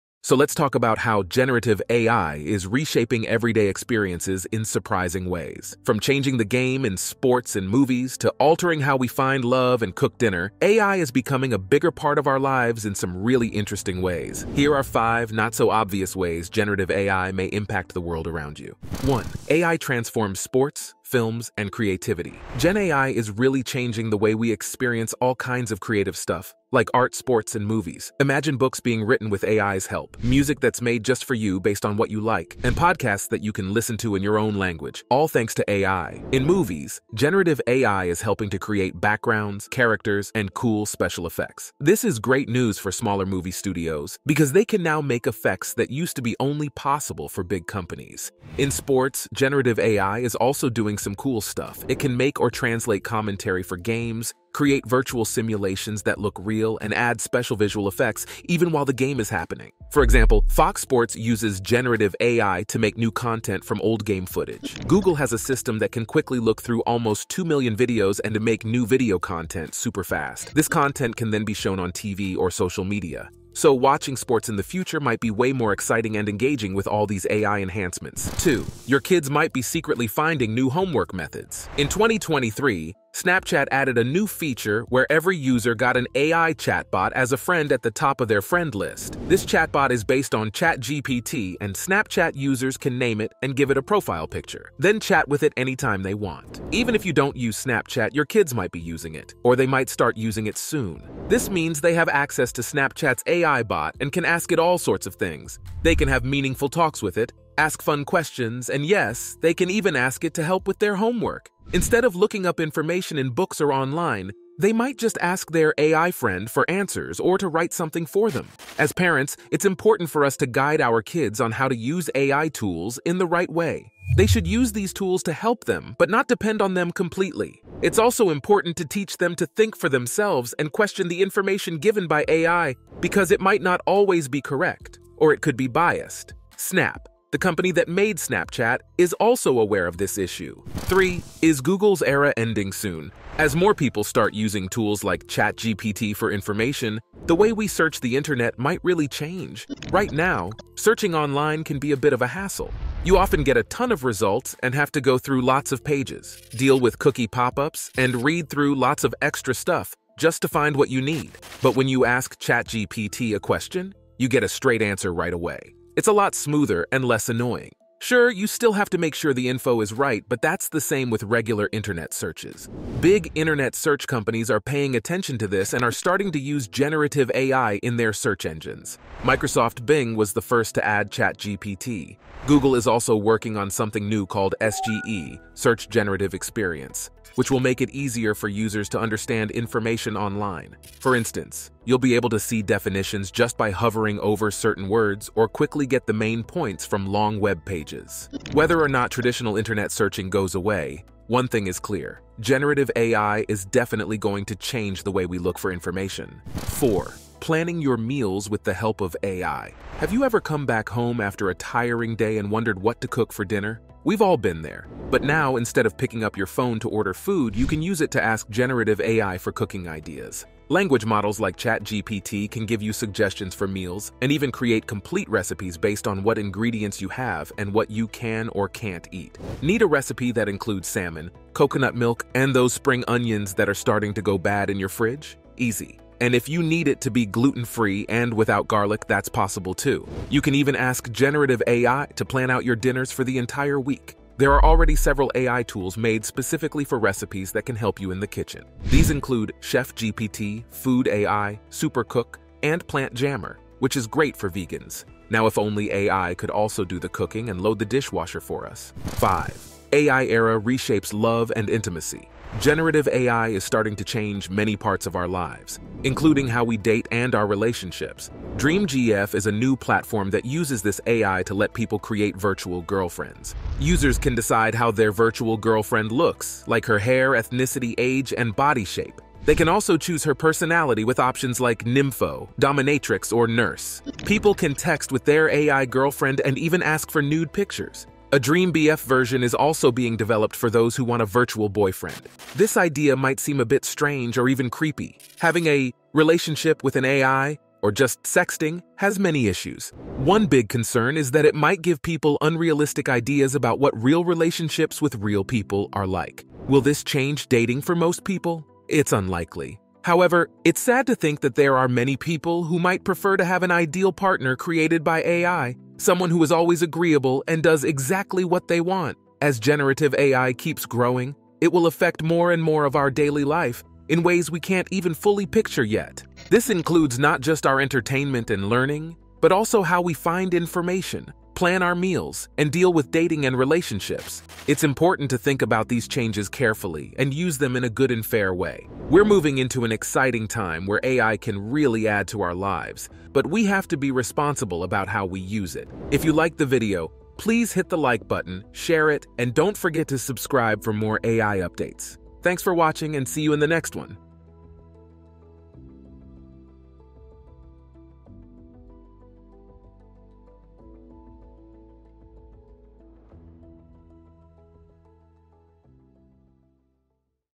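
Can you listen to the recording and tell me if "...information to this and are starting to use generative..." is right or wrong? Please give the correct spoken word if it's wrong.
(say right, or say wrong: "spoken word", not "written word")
wrong: "attention", not "information".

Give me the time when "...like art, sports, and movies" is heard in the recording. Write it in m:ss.
0:26.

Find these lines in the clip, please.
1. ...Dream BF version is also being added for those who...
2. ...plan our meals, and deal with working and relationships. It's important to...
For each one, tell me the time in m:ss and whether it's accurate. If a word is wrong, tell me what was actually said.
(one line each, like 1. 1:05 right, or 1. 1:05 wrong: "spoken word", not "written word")
1. 4:48 wrong: "developed", not "added"
2. 5:31 wrong: "dating", not "working".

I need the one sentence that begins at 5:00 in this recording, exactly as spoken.
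One big concern is that it might give people unrealistic ideas about what real relationships with real people are like.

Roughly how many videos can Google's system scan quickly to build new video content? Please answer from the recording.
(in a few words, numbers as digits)
2 million.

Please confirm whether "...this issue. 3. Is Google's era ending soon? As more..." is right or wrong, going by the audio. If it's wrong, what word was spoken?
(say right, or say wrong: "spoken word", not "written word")
right.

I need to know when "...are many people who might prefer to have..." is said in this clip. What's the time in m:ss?
5:11.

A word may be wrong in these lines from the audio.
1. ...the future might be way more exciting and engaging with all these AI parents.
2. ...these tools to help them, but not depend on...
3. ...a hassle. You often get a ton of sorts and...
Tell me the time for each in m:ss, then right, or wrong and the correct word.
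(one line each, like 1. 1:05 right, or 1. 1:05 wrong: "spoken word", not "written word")
1. 1:14 wrong: "enhancements", not "parents"
2. 2:04 right
3. 2:32 wrong: "results", not "sorts".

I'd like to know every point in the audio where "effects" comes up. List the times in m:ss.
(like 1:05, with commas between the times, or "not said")
0:41, 0:45, 0:57.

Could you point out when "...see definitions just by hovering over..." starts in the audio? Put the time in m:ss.
3:12.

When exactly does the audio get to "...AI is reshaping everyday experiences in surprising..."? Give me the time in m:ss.
0:01.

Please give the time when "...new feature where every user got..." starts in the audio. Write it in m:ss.
1:24.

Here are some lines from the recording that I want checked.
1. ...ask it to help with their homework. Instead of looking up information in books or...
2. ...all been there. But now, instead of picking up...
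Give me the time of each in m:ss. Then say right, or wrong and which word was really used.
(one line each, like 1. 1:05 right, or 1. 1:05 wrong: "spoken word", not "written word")
1. 1:49 right
2. 3:34 right.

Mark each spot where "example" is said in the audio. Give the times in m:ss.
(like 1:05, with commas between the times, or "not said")
1:00.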